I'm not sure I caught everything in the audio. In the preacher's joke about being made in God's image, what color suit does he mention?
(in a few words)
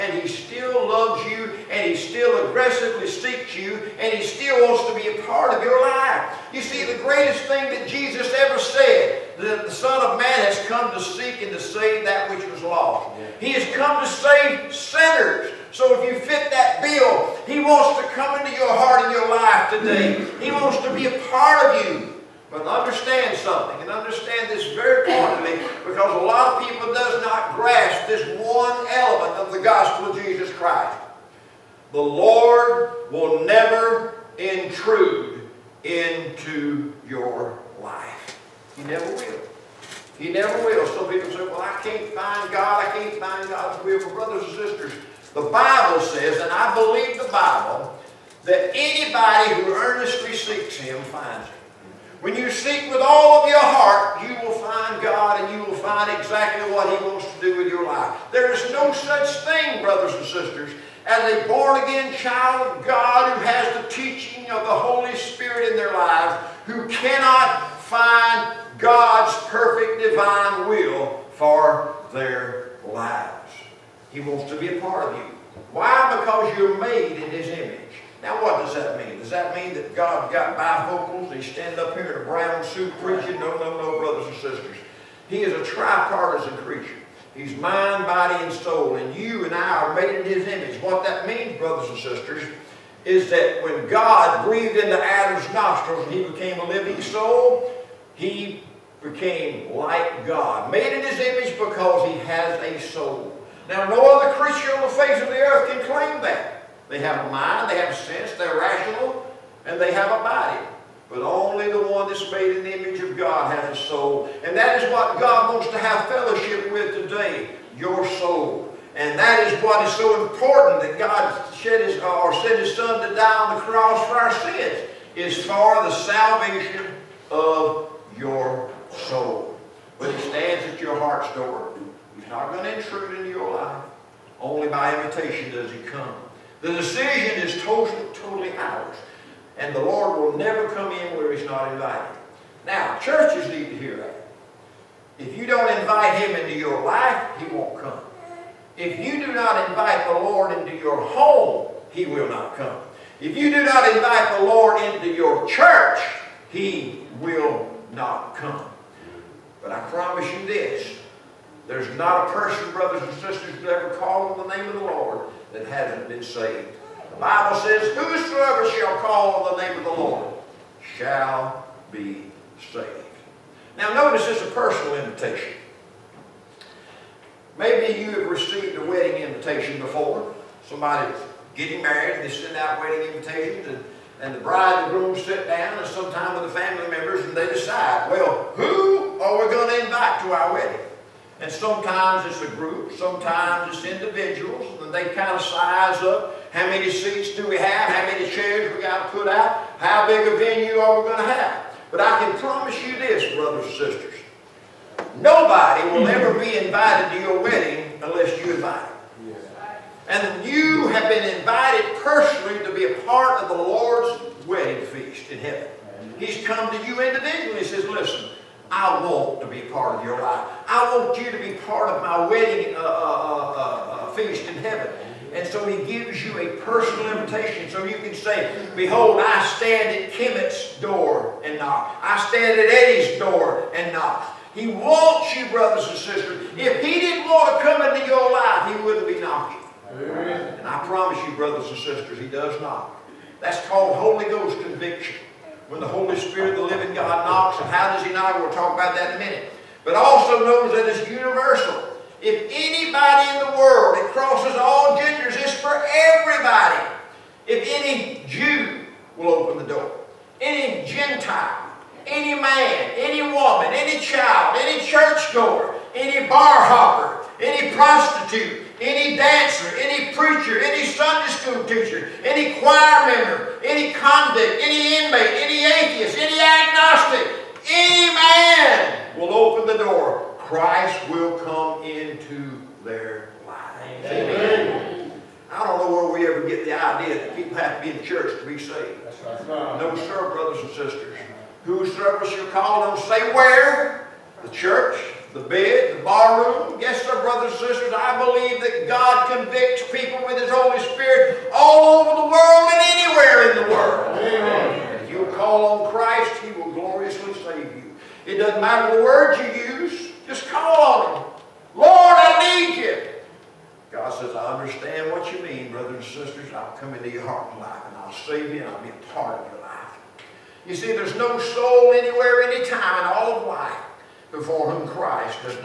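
Brown.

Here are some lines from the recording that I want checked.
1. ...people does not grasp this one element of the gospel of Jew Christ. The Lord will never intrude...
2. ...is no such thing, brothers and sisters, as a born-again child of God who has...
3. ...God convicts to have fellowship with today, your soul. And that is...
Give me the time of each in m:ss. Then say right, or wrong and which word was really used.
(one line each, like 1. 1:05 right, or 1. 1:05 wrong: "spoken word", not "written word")
1. 0:26 wrong: "Jesus", not "Jew"
2. 0:58 right
3. 1:55 wrong: "wants", not "convicts".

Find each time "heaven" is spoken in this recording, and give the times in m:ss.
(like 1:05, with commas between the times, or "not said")
3:35, 3:44.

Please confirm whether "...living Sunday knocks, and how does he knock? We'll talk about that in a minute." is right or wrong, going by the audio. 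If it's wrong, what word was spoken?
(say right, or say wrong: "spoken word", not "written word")
wrong: "God", not "Sunday".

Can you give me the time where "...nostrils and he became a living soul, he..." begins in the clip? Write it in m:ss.
1:35.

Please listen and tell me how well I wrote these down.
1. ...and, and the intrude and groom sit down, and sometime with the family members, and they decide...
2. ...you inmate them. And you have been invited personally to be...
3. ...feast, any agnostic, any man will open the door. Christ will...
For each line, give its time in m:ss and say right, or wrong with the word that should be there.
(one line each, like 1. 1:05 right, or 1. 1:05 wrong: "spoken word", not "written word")
1. 3:03 wrong: "bride", not "intrude"
2. 3:28 wrong: "invite", not "inmate"
3. 4:35 wrong: "atheist", not "feast".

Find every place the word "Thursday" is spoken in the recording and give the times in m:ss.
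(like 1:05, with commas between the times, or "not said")
not said.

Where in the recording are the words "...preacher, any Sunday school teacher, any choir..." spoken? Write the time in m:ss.
4:30.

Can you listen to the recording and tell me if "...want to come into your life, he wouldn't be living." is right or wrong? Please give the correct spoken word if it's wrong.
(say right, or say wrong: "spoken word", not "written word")
wrong: "knocking", not "living".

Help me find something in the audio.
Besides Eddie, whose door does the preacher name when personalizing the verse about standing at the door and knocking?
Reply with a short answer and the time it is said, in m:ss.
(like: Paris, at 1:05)
Kimmett, at 3:50.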